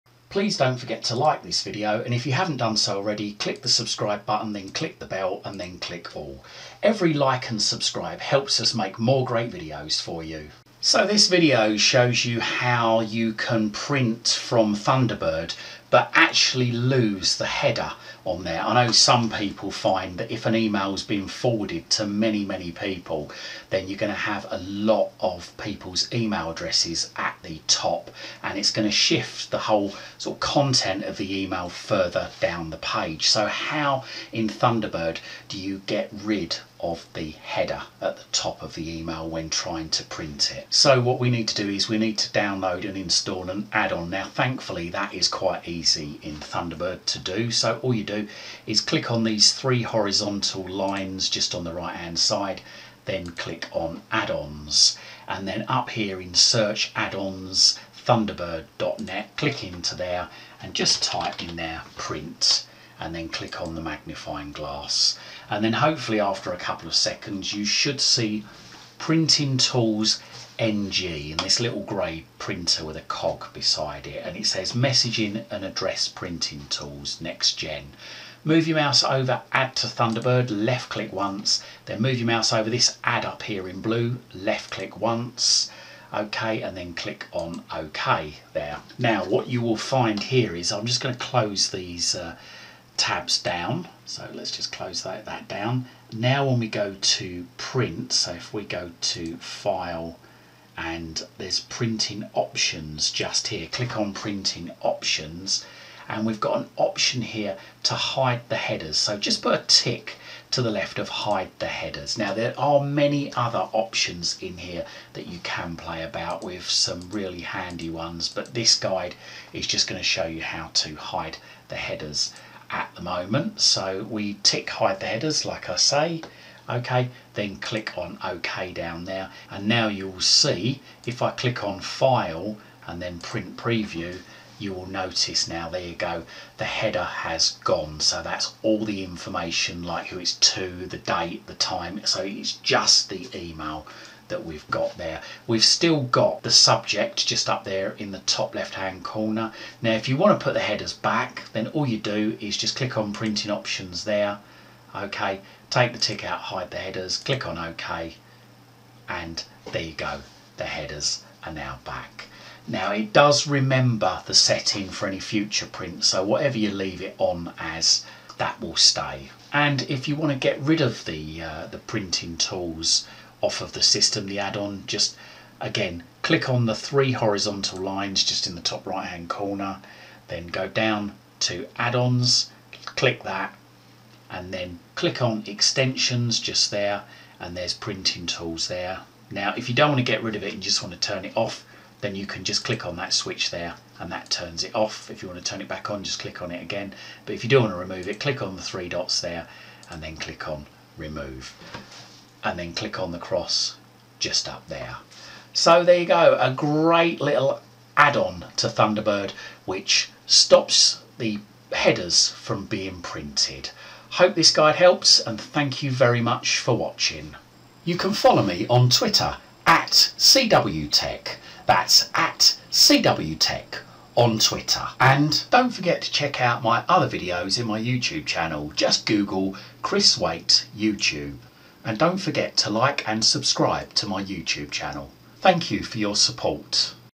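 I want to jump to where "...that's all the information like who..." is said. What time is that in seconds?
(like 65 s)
138 s.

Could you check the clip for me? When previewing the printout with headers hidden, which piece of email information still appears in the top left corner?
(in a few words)
The subject.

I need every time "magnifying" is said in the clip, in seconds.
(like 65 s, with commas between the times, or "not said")
63 s.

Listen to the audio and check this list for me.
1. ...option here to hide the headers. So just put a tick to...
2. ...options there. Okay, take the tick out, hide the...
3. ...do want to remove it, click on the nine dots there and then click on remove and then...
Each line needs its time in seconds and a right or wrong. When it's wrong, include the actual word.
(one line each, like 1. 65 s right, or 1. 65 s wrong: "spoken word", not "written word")
1. 106 s right
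2. 153 s right
3. 197 s wrong: "three", not "nine".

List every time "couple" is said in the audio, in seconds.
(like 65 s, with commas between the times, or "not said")
66 s.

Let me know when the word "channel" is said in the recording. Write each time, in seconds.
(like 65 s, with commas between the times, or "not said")
228 s, 234 s.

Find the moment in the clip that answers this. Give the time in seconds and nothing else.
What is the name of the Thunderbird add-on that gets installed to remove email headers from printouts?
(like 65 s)
68 s.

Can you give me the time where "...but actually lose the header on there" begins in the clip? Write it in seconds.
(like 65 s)
15 s.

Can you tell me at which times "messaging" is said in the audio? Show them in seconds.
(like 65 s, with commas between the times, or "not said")
74 s.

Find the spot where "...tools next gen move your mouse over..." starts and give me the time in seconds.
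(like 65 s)
76 s.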